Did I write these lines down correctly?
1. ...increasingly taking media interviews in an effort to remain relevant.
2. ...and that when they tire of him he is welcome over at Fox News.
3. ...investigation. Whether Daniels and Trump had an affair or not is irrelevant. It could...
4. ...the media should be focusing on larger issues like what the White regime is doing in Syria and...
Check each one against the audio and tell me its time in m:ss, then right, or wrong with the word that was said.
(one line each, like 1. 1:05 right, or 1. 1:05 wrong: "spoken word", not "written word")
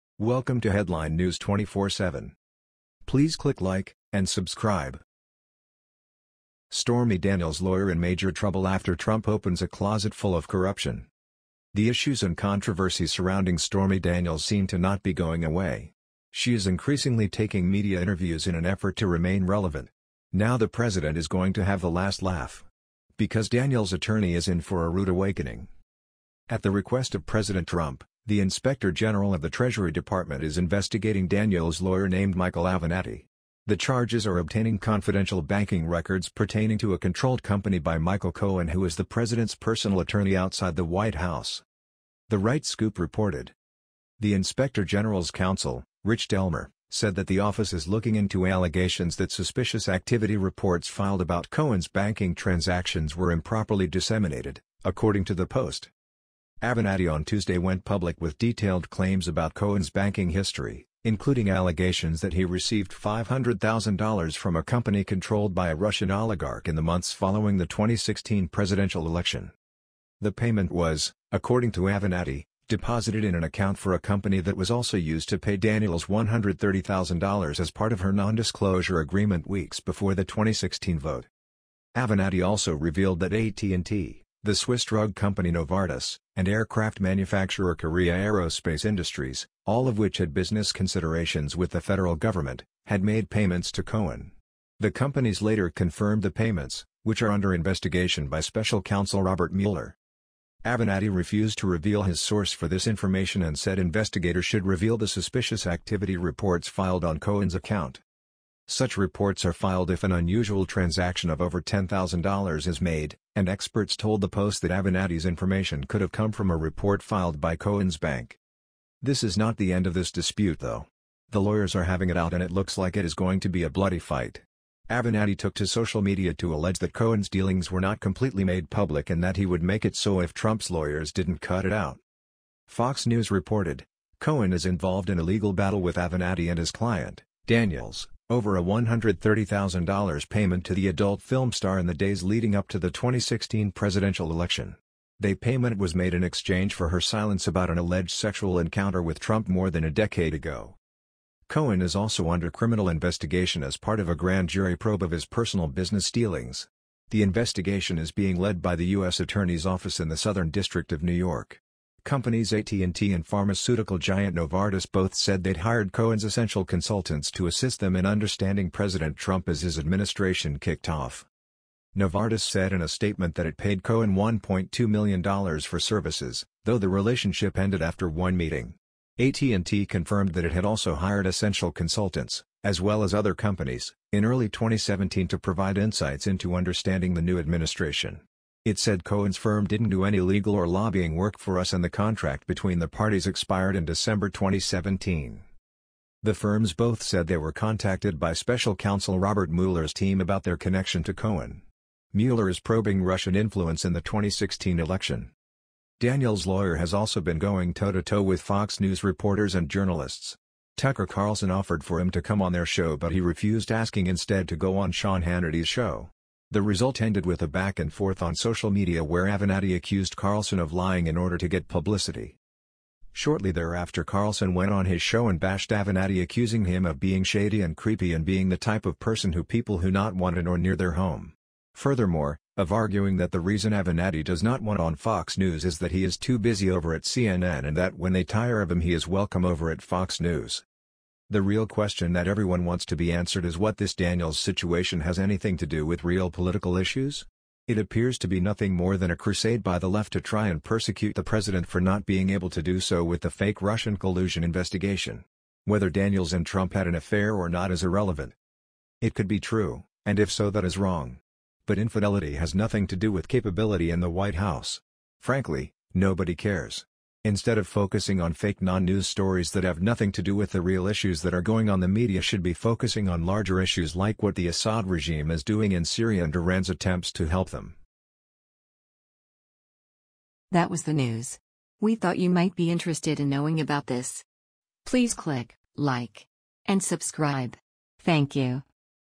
1. 0:16 right
2. 3:57 right
3. 4:14 right
4. 4:31 wrong: "Assad", not "White".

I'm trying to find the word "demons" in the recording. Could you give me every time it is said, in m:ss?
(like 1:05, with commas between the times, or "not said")
not said.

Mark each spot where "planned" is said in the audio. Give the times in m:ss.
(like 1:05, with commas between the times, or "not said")
not said.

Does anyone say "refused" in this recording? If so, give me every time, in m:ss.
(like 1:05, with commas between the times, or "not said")
1:41, 3:33.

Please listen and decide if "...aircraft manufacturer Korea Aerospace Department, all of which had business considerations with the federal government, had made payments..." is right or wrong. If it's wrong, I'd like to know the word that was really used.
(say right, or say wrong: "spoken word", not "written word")
wrong: "Industries", not "Department".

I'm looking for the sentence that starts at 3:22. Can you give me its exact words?
Mueller is probing Russian influence in the 2016 election.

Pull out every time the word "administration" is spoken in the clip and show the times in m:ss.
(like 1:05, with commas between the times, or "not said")
2:49, 3:07.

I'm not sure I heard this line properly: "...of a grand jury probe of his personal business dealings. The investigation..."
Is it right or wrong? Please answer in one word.
right.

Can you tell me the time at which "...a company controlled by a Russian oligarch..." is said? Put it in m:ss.
1:04.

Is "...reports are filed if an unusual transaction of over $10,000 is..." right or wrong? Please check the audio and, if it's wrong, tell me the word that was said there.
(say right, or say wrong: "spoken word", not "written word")
right.